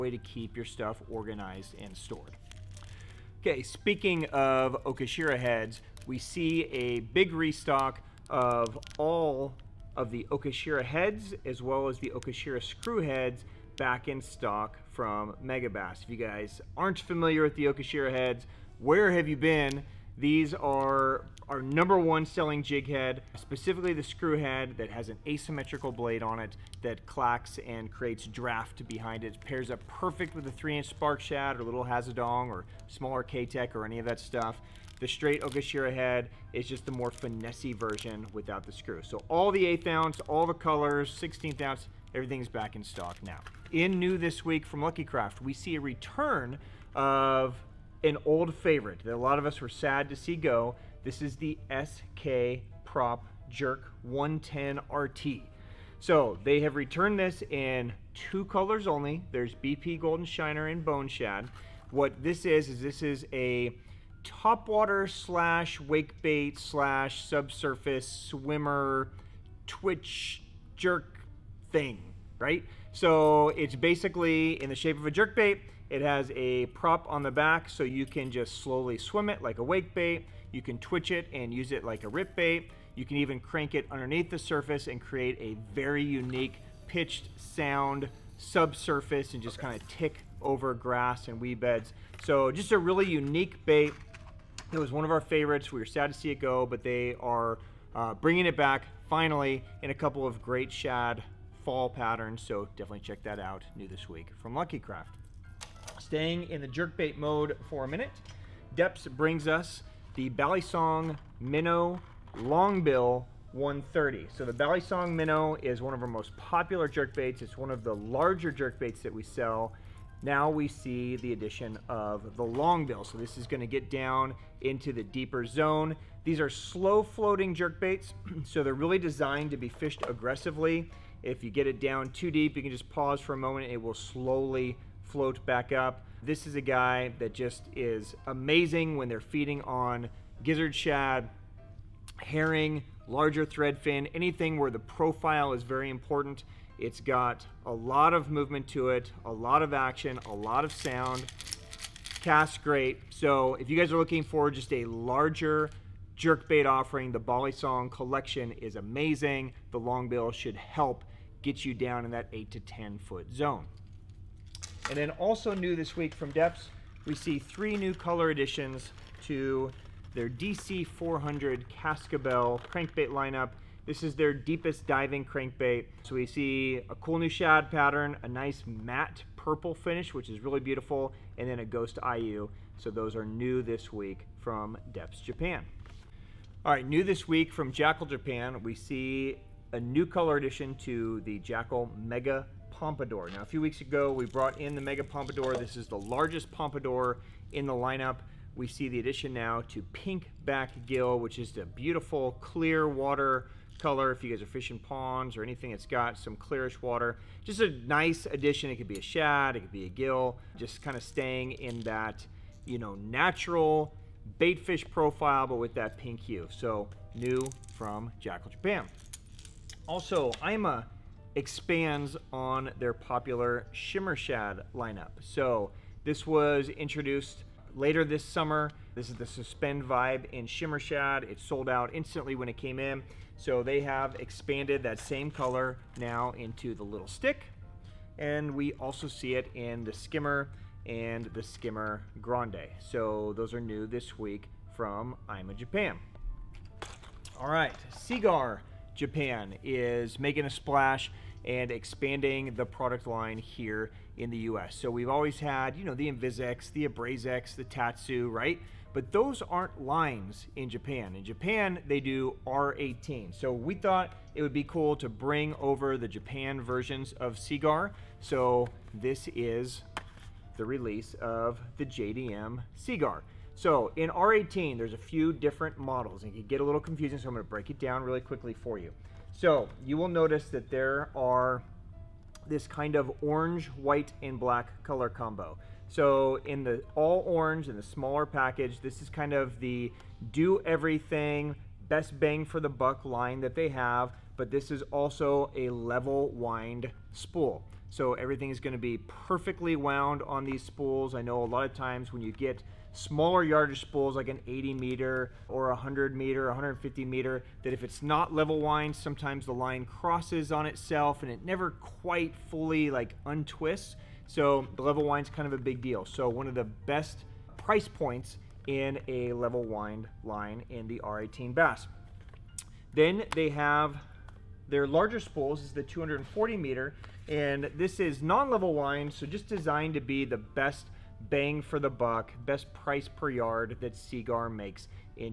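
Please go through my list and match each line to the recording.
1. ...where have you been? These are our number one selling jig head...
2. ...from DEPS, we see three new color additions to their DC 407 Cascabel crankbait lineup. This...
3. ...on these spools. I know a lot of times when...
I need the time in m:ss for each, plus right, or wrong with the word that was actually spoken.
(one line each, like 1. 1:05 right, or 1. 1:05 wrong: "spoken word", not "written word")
1. 0:18 right
2. 2:46 wrong: "400", not "407"
3. 5:00 right.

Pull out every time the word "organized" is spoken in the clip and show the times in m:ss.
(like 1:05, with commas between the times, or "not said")
0:01.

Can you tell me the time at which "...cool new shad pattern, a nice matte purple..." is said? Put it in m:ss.
2:56.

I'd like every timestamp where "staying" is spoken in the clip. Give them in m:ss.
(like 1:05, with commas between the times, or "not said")
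1:45, 3:31.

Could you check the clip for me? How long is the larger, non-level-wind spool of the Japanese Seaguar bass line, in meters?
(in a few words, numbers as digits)
240 meters.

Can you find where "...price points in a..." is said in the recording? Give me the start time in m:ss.
5:17.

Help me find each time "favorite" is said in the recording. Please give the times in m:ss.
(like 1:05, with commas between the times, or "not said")
0:48, 1:35.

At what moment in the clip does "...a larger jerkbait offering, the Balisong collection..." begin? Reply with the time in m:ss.
2:34.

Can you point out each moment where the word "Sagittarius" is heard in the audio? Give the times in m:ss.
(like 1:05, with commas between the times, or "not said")
not said.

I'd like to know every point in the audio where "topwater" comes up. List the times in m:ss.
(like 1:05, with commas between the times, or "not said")
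1:04.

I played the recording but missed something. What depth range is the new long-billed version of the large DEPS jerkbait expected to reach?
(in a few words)
8 to 10 feet.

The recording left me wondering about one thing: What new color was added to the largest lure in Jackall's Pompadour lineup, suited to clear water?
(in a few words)
pink back gill.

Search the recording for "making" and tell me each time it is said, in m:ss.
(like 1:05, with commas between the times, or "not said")
4:10.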